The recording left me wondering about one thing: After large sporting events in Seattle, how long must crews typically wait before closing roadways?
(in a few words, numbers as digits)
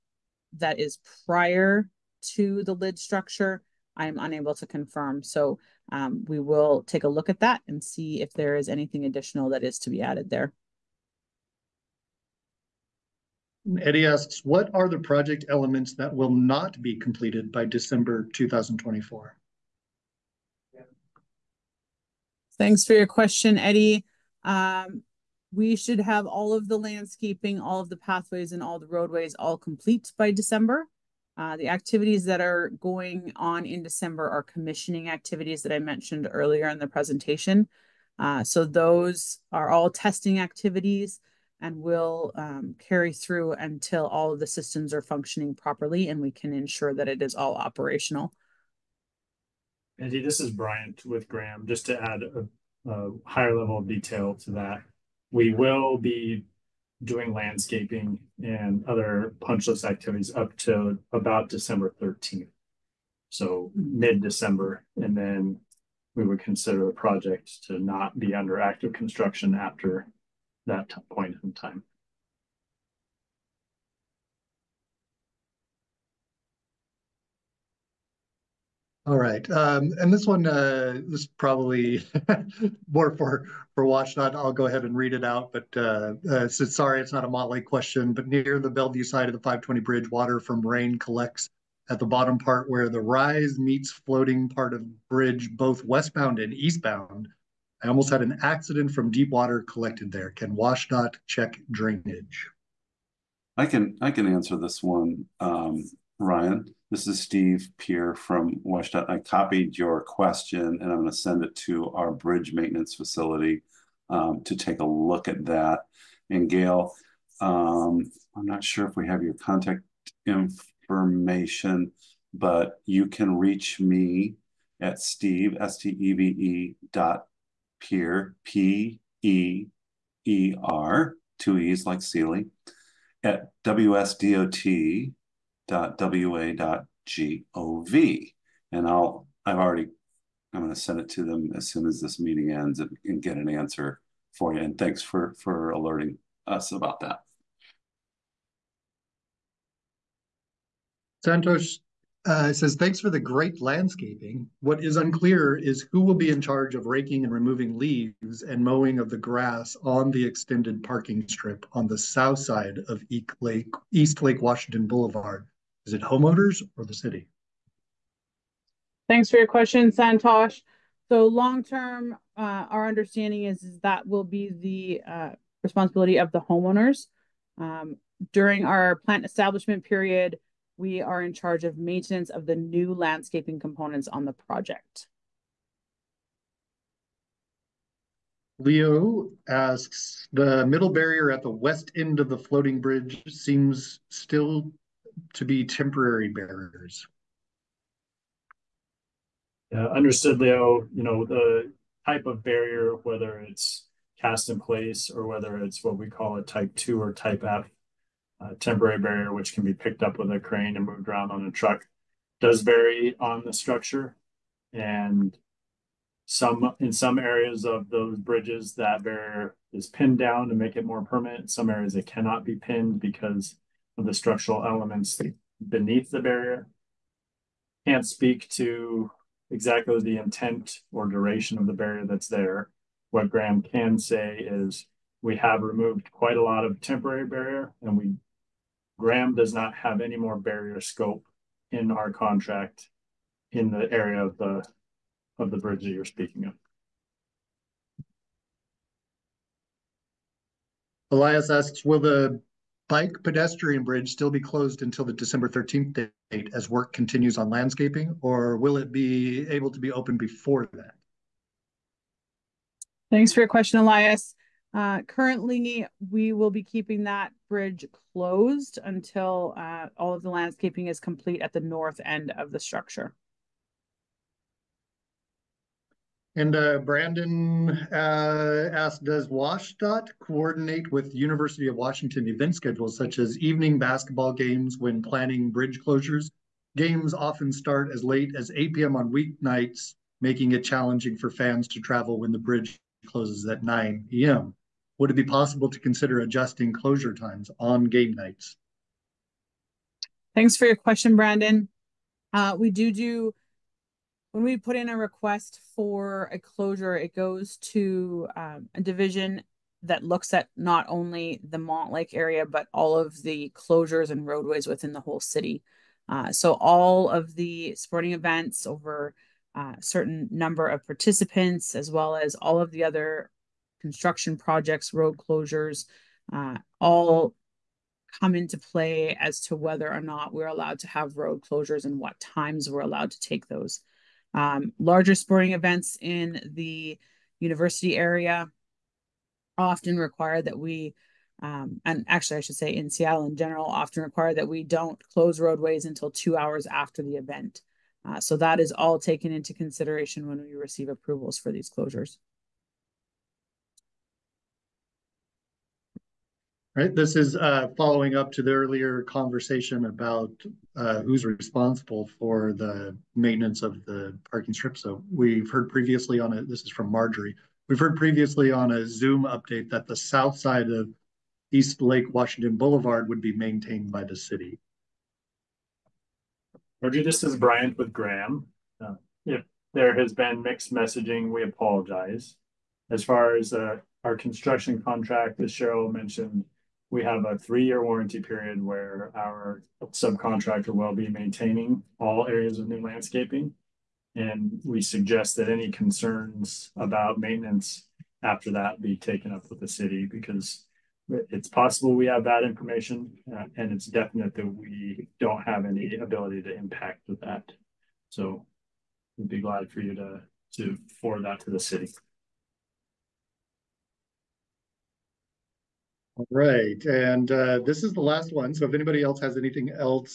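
two hours.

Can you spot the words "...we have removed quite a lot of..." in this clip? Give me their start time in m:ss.
3:55.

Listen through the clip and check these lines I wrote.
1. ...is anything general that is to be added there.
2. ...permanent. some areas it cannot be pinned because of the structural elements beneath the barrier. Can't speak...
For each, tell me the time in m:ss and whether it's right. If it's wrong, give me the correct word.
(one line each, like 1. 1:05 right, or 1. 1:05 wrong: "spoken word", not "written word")
1. 0:08 wrong: "additional", not "general"
2. 3:41 right.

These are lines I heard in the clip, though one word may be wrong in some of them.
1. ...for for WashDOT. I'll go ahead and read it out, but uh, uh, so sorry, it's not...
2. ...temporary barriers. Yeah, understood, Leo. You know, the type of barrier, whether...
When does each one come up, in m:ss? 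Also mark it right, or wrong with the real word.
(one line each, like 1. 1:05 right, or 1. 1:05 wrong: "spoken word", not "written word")
1. 1:23 right
2. 3:15 right.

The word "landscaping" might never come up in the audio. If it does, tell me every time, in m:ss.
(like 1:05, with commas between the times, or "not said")
0:26, 0:57, 2:33, 3:02, 4:17, 4:30, 6:32.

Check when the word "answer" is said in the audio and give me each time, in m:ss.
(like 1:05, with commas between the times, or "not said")
1:44, 2:23.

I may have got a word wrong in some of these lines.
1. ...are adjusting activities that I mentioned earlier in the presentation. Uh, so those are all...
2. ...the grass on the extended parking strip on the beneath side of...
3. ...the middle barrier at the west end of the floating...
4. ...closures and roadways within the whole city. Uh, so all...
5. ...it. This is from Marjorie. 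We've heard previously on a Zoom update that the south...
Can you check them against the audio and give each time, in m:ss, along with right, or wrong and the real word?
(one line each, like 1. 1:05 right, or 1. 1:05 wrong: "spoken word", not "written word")
1. 0:34 wrong: "commissioning", not "adjusting"
2. 2:39 wrong: "south", not "beneath"
3. 3:10 right
4. 5:13 right
5. 6:06 right.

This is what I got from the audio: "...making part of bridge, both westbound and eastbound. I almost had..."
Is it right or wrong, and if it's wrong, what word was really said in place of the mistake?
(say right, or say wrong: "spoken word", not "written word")
wrong: "floating", not "making".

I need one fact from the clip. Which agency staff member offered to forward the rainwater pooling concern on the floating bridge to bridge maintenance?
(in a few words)
Steve Peer.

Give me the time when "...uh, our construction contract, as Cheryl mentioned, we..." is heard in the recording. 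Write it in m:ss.
6:23.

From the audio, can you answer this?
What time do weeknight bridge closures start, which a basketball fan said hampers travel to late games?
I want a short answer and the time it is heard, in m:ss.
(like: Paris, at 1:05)
9 p.m., at 4:53.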